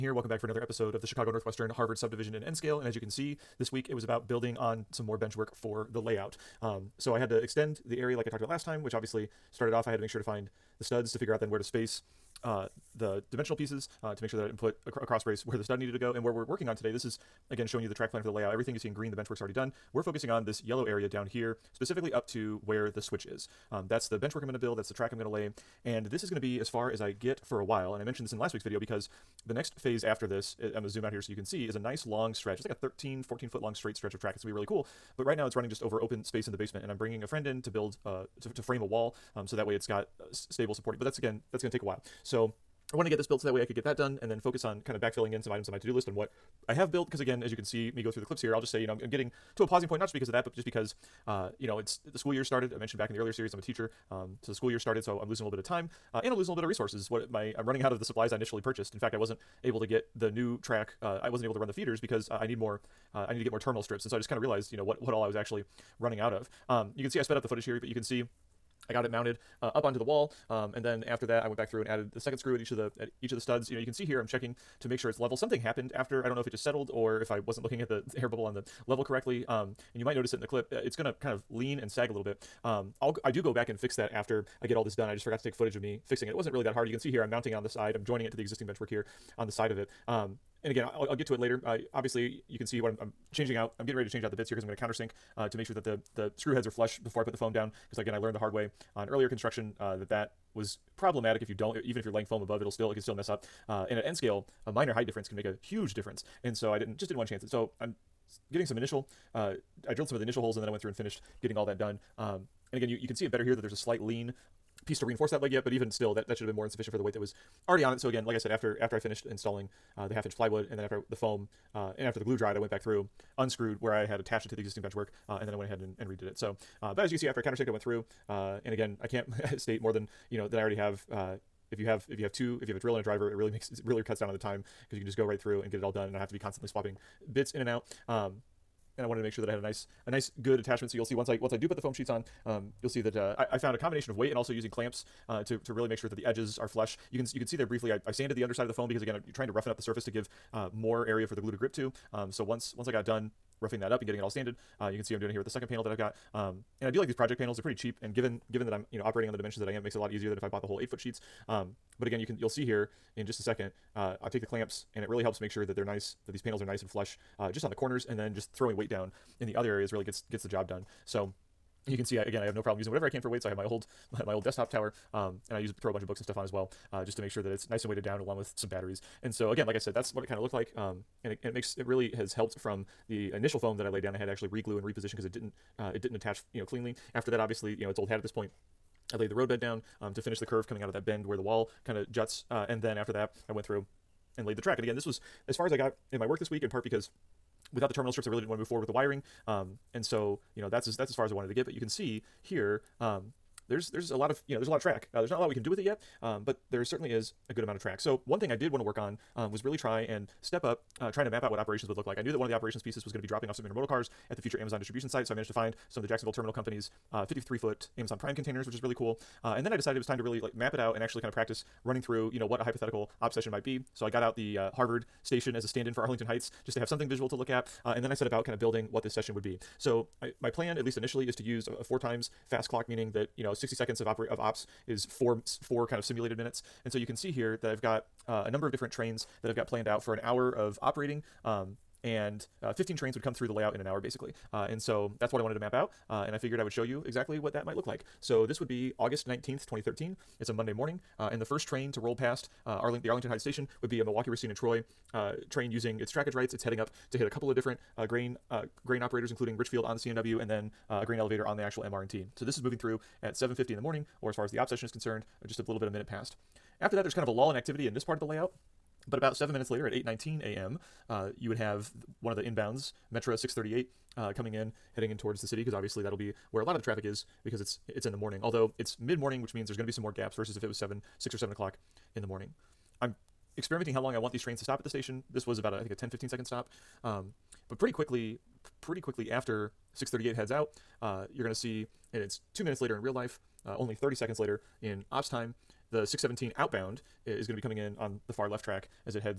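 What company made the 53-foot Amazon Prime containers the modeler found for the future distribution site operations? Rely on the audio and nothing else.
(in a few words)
Jacksonville Terminal Company.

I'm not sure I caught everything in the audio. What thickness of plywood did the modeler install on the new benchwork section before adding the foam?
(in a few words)
half inch.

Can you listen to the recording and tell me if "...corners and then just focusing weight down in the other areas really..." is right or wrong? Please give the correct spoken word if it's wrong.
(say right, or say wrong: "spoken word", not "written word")
wrong: "throwing", not "focusing".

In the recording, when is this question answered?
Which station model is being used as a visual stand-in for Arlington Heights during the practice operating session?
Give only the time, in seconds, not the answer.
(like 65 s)
224 s.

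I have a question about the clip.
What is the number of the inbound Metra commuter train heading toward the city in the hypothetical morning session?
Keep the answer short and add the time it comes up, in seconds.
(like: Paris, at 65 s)
638, at 273 s.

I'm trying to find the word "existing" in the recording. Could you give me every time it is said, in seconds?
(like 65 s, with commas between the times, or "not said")
88 s, 124 s.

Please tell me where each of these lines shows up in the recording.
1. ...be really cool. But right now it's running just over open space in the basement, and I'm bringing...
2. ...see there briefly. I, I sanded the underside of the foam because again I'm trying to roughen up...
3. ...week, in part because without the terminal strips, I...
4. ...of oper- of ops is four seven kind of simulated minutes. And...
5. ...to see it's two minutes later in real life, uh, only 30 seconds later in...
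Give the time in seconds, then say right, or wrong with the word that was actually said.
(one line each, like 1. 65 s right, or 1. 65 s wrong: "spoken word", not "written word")
1. 34 s right
2. 147 s right
3. 196 s right
4. 234 s wrong: "four", not "seven"
5. 291 s right.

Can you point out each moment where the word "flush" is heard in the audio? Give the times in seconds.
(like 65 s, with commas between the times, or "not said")
96 s, 146 s, 166 s.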